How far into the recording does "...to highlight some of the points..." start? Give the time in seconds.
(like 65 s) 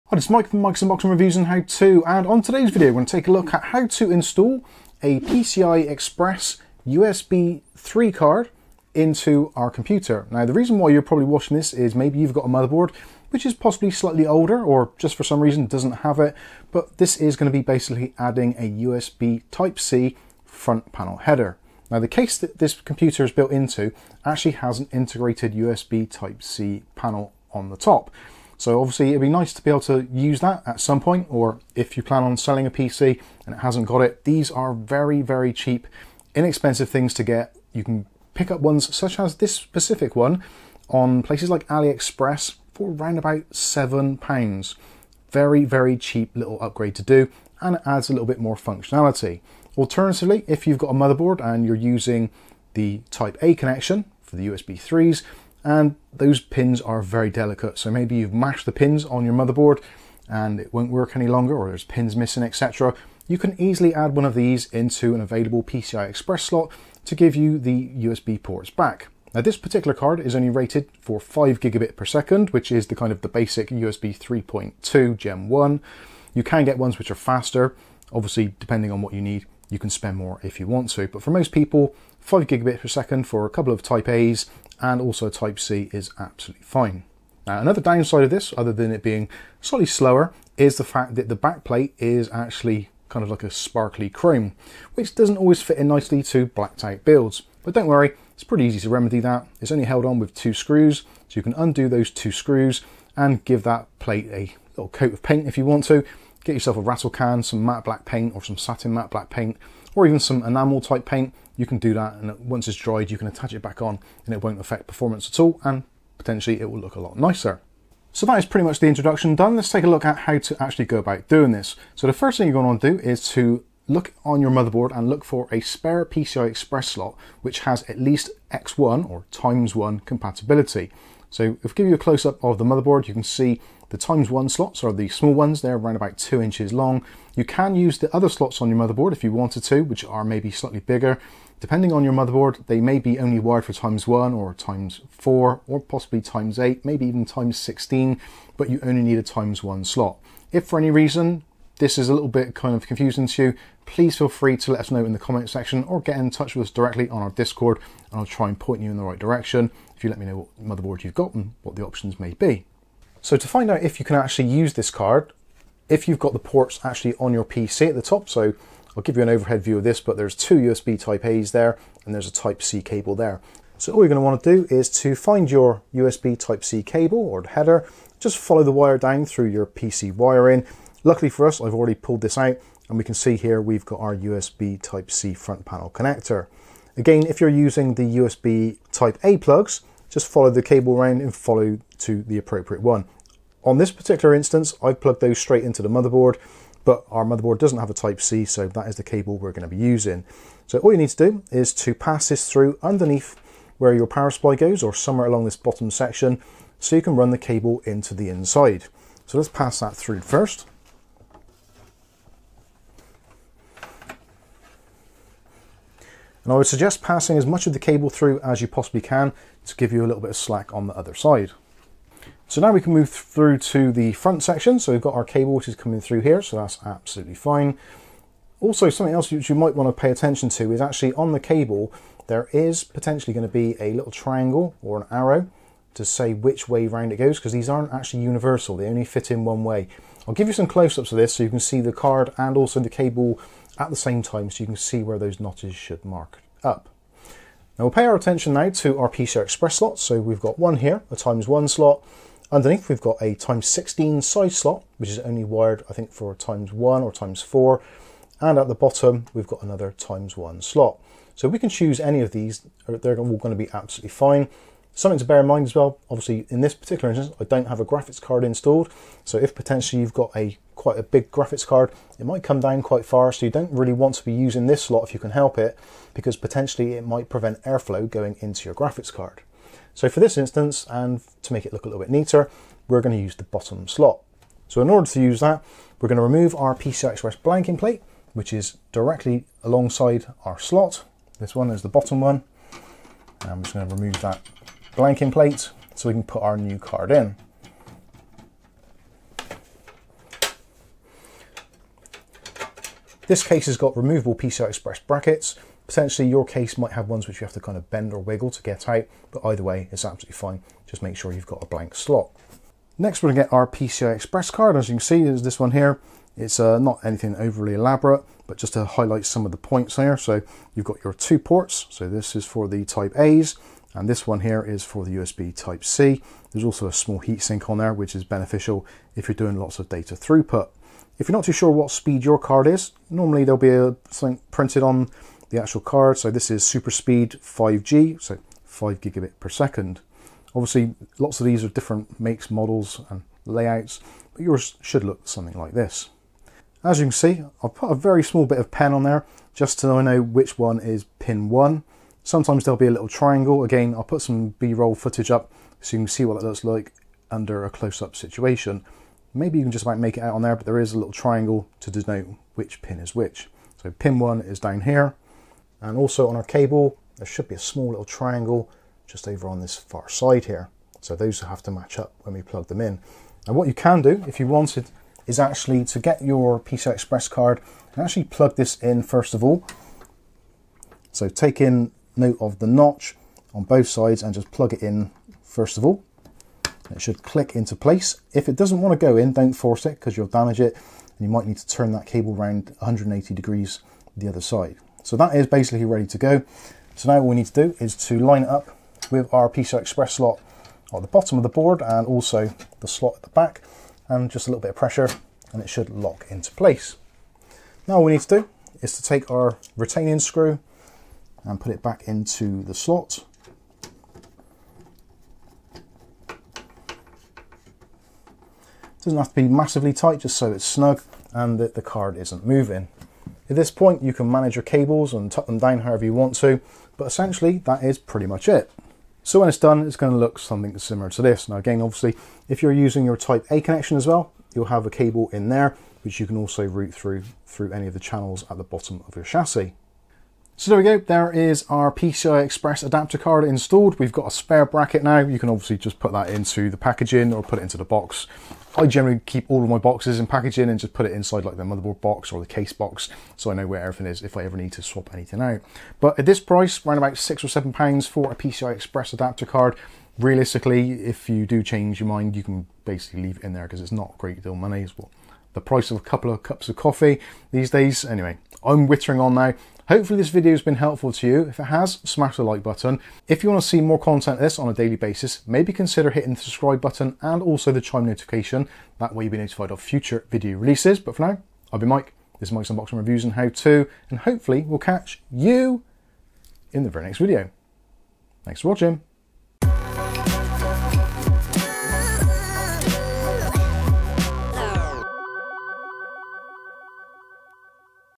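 318 s.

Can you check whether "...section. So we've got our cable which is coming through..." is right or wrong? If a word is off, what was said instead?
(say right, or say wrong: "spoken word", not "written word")
right.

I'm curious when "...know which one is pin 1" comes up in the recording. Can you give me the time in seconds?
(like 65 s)
350 s.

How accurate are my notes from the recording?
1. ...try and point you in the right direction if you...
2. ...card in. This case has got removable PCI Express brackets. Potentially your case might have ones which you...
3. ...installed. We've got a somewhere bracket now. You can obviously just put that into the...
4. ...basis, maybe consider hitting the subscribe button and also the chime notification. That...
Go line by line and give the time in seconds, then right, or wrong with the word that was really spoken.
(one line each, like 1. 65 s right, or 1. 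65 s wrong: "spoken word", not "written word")
1. 158 s right
2. 296 s right
3. 443 s wrong: "spare", not "somewhere"
4. 474 s right.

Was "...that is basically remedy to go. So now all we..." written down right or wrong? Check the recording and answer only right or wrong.
wrong.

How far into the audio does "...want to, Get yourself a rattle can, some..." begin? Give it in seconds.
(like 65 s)
105 s.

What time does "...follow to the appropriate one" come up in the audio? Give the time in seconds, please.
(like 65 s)
191 s.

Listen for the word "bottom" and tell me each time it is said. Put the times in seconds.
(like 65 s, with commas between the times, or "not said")
205 s, 258 s, 283 s, 291 s, 401 s, 438 s.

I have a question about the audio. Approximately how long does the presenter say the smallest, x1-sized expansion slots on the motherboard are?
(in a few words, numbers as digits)
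2 inches.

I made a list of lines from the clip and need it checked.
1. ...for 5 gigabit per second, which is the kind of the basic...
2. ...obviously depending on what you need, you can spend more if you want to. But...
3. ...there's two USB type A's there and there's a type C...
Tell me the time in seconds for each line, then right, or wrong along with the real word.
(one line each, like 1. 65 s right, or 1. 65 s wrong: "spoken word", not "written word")
1. 70 s right
2. 78 s right
3. 170 s right.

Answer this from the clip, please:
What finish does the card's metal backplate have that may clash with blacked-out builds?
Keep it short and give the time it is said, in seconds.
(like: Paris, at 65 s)
sparkly chrome, at 93 s.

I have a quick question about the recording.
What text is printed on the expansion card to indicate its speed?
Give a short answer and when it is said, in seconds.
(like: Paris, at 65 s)
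super speed 5G, at 336 s.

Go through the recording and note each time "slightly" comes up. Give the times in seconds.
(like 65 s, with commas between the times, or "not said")
13 s, 89 s, 140 s.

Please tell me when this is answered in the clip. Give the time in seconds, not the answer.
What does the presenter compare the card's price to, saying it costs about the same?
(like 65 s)
465 s.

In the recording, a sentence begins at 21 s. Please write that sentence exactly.
Now the case that this computer is built into actually has an integrated USB Type-C panel on the top.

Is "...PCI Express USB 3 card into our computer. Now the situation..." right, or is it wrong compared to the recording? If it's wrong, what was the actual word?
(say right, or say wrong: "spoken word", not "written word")
wrong: "reason", not "situation".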